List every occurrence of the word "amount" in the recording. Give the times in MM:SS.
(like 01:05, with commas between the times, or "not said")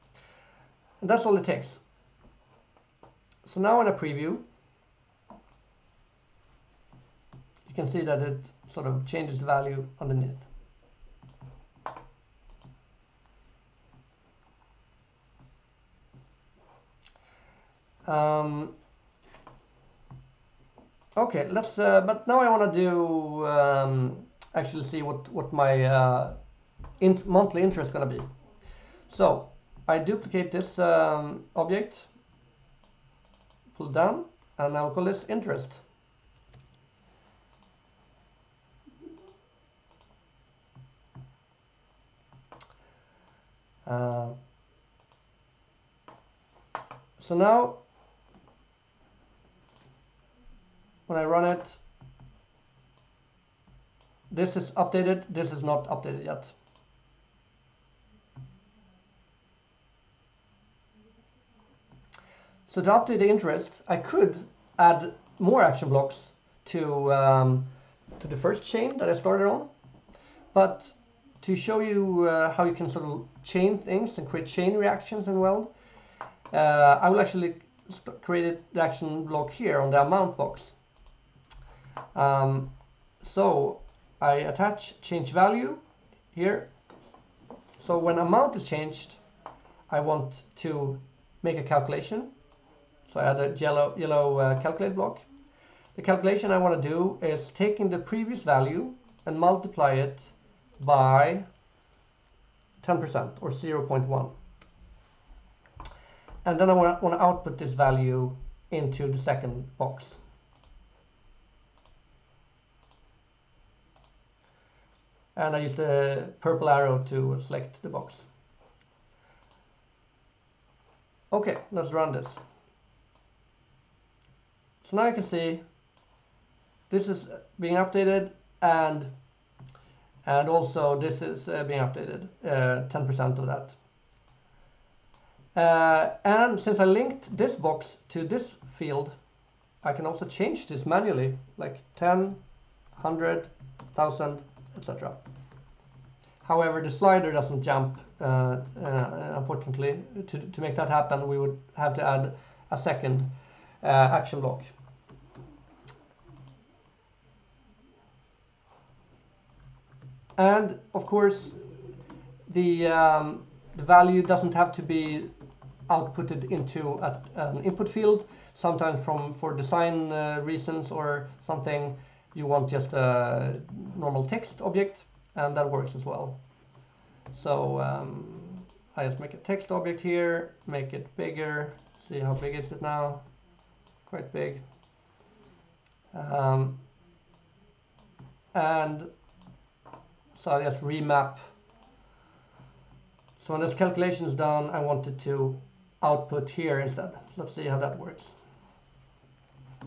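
01:19, 01:28.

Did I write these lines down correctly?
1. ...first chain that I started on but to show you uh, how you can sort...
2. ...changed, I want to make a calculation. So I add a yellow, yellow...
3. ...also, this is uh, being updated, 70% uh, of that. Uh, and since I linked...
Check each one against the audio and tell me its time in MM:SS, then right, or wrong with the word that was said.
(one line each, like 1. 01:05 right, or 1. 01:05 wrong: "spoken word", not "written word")
1. 01:08 right
2. 01:28 right
3. 02:10 wrong: "10", not "70".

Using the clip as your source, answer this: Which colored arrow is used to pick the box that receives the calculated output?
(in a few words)
purple.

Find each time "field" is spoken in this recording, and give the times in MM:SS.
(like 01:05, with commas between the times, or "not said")
02:18, 02:47.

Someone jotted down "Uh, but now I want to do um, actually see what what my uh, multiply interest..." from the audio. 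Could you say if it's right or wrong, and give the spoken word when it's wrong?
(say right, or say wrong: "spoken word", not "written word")
wrong: "monthly", not "multiply".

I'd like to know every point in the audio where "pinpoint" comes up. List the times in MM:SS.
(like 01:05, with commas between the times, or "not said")
not said.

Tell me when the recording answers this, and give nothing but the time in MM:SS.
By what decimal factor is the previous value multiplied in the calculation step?
01:43.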